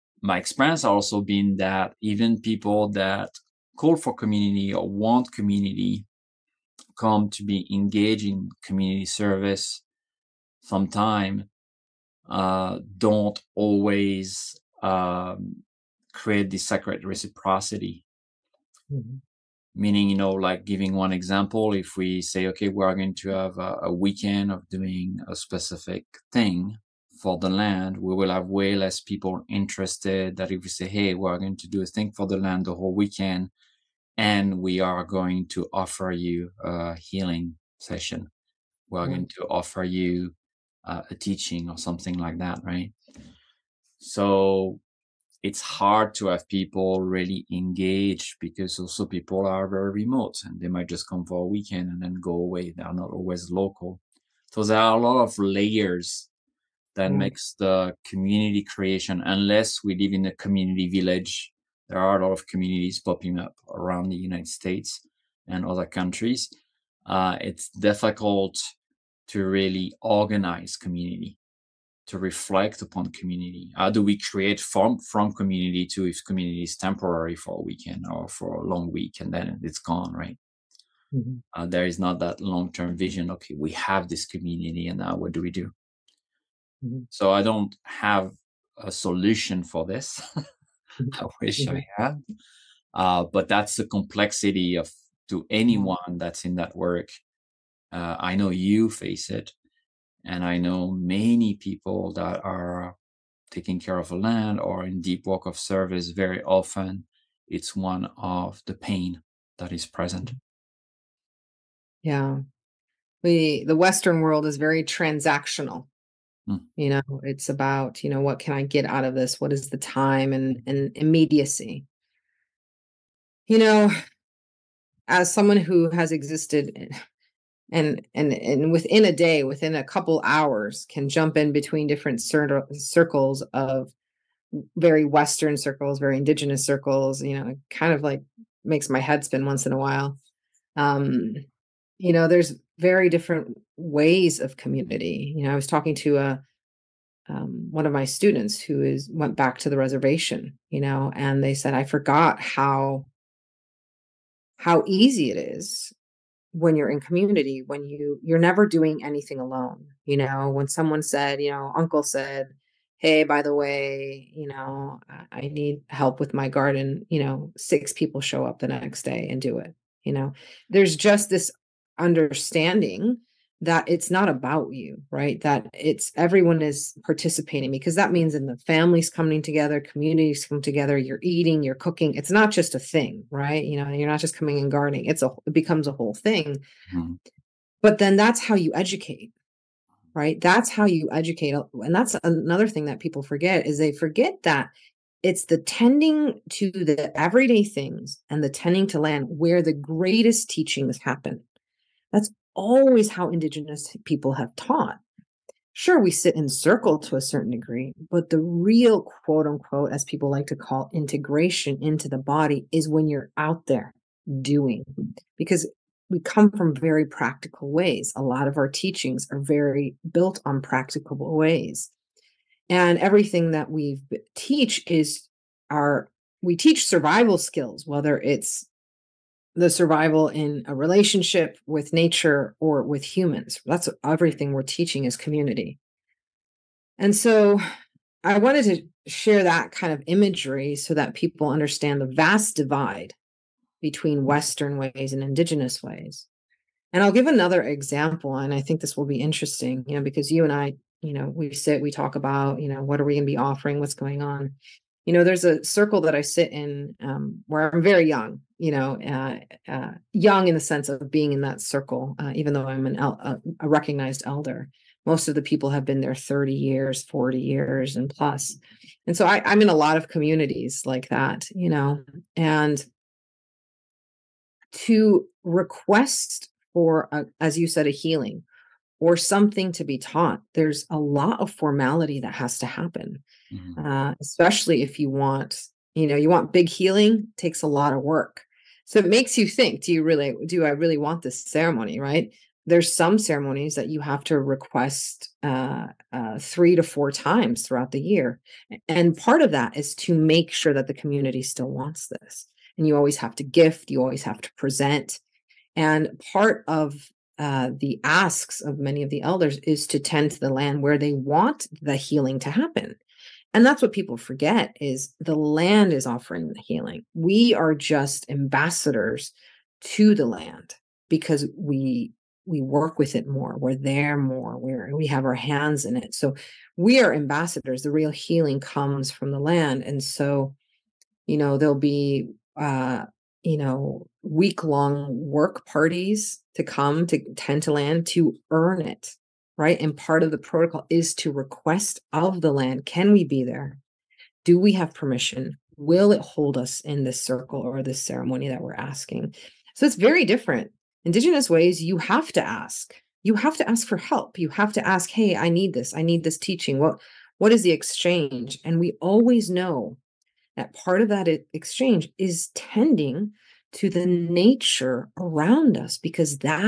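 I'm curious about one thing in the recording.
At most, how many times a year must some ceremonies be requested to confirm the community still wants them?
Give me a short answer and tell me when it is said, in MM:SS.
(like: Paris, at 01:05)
4, at 04:56.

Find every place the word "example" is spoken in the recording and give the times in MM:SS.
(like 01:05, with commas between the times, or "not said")
00:21, 04:07.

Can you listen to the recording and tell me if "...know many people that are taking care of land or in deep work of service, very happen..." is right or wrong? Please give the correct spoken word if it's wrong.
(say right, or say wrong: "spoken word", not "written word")
wrong: "often", not "happen".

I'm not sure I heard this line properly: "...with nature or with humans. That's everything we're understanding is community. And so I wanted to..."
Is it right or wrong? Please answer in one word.
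wrong.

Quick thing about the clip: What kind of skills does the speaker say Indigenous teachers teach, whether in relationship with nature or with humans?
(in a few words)
survival skills.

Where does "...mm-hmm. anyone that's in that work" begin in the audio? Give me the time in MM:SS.
01:35.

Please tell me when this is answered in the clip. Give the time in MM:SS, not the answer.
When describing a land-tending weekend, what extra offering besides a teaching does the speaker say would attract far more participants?
00:36.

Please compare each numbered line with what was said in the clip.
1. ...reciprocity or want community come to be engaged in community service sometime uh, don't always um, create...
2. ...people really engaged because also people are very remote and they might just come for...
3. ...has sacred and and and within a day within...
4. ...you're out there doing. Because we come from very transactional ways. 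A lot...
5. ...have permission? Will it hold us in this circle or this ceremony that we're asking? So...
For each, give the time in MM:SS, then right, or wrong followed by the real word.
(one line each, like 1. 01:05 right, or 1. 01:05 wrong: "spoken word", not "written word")
1. 00:04 wrong: "community", not "reciprocity"
2. 00:46 right
3. 02:05 wrong: "existed", not "sacred"
4. 03:33 wrong: "practical", not "transactional"
5. 05:44 right.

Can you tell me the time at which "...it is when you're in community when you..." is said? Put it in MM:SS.
02:35.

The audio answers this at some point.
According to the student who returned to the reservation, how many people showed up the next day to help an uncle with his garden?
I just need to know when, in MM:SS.
02:47.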